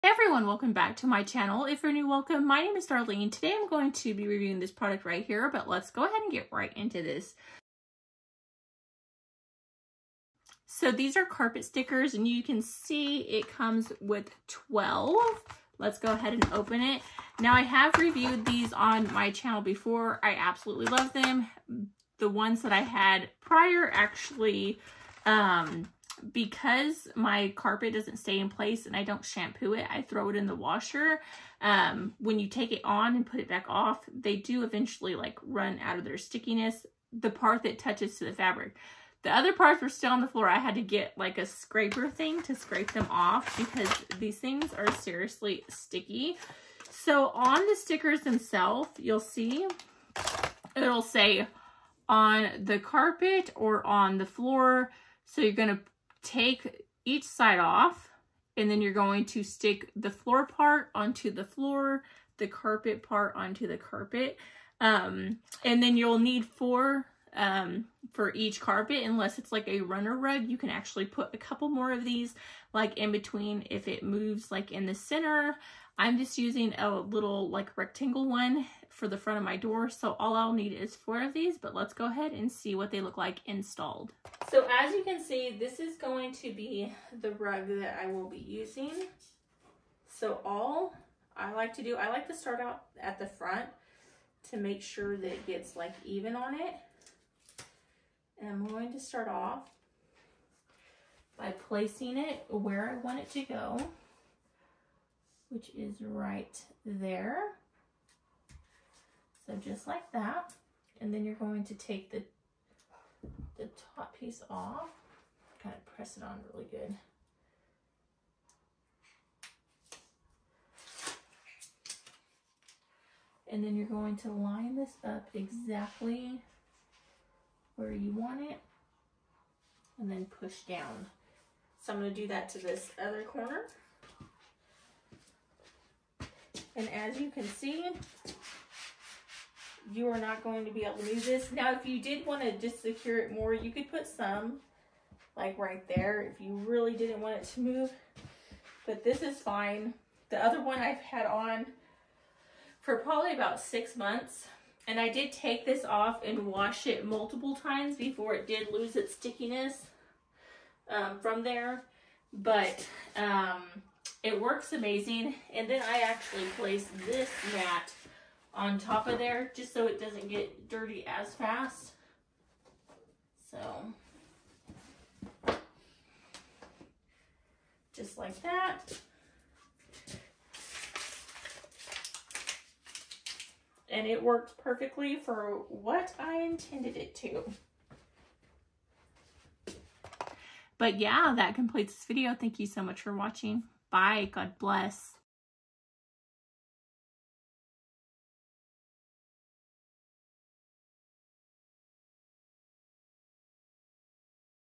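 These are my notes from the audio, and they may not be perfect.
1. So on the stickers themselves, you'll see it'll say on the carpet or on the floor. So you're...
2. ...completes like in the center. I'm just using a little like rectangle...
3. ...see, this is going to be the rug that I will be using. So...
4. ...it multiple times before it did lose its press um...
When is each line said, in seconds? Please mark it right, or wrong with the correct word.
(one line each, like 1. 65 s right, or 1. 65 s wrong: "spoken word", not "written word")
1. 46 s right
2. 74 s wrong: "moves", not "completes"
3. 85 s right
4. 156 s wrong: "stickiness", not "press".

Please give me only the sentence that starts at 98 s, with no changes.
And I'm going to start off by placing it where I want it to go, which is right there.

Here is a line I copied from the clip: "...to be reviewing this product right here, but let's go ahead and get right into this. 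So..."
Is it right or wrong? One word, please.
right.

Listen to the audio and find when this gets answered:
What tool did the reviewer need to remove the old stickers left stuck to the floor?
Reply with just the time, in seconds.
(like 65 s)
41 s.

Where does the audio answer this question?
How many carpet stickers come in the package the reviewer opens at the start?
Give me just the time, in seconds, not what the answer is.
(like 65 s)
14 s.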